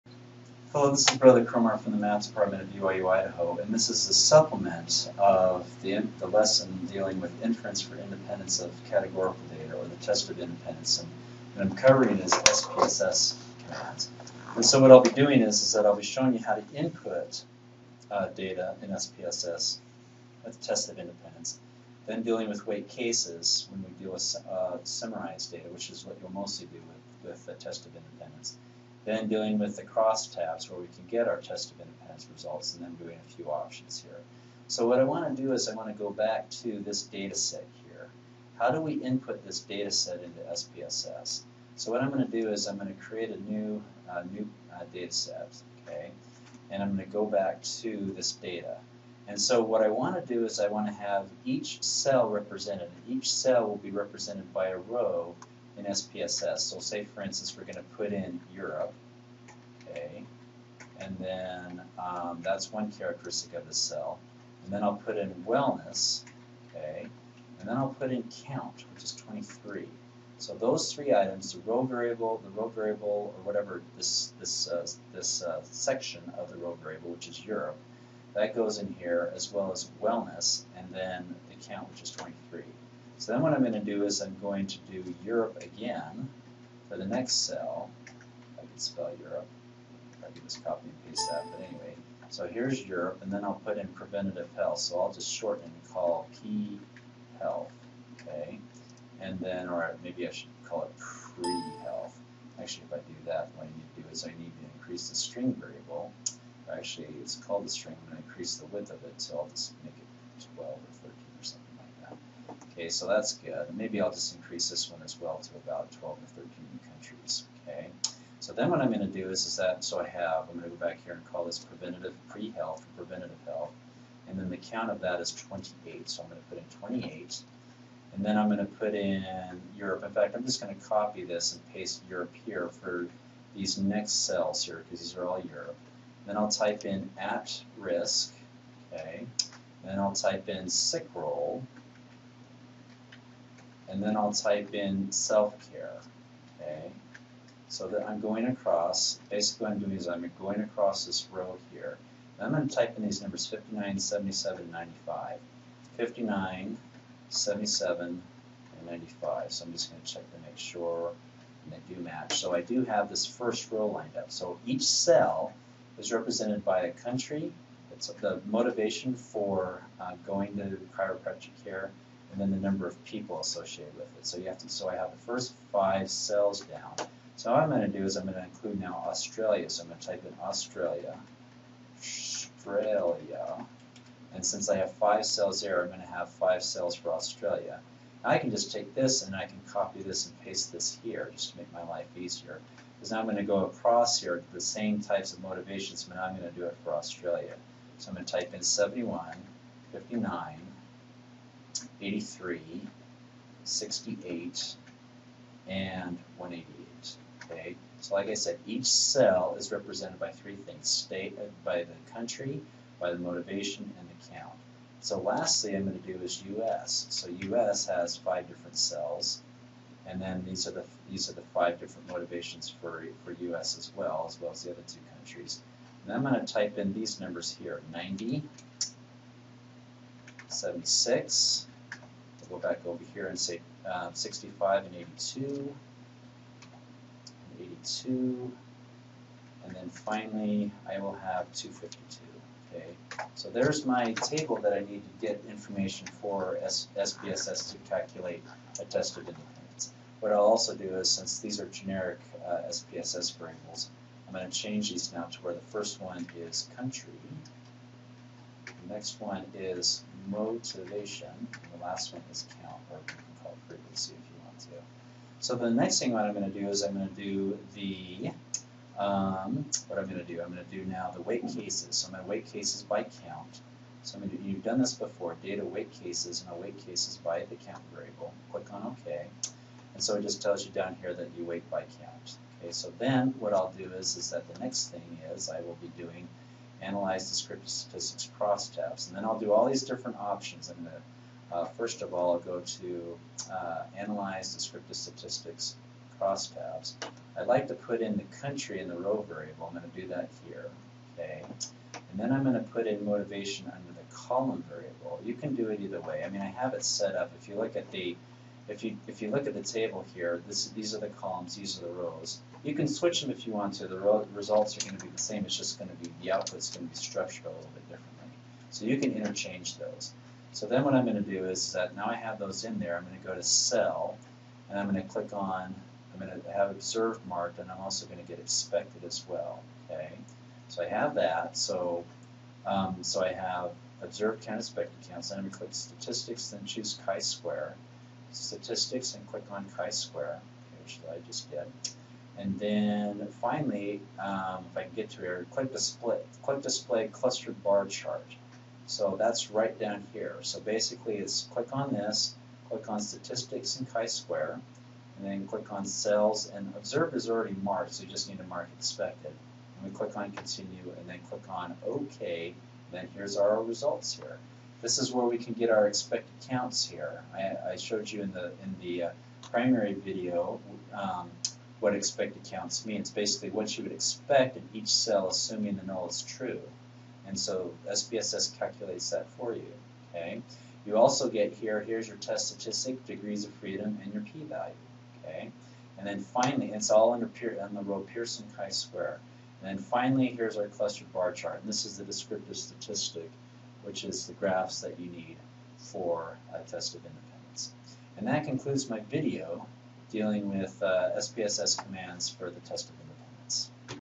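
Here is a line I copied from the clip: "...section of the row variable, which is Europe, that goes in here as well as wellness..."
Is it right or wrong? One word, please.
right.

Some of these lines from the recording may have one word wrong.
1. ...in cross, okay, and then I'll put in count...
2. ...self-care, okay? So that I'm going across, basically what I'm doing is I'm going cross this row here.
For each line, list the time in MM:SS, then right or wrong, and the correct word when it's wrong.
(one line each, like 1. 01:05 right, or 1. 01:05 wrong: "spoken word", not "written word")
1. 01:05 wrong: "wellness", not "cross"
2. 02:25 wrong: "across", not "cross".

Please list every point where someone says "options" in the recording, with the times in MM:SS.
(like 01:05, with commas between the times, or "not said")
00:33, 04:50.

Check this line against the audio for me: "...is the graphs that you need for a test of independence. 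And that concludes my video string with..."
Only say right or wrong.
wrong.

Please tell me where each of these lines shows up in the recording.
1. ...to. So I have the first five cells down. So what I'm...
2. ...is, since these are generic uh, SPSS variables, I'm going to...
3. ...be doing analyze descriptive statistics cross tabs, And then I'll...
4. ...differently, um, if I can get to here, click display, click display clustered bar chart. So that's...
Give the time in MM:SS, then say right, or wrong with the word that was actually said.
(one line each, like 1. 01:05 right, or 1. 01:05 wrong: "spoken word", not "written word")
1. 02:54 right
2. 04:10 right
3. 04:45 right
4. 05:43 wrong: "finally", not "differently".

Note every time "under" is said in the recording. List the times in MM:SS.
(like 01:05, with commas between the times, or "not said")
05:03, 06:27.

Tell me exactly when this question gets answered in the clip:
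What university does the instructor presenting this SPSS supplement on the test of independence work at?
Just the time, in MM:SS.
00:02.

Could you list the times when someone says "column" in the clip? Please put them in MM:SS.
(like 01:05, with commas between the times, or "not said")
05:04, 05:11.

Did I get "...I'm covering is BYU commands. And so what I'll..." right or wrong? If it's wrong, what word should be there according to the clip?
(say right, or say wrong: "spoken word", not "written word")
wrong: "SPSS", not "BYU".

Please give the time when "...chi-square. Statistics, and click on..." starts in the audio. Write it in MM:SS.
05:37.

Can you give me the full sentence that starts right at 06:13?
Basically, what you would expect in each cell, assuming the null is true.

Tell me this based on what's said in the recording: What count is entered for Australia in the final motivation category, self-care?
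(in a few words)
188.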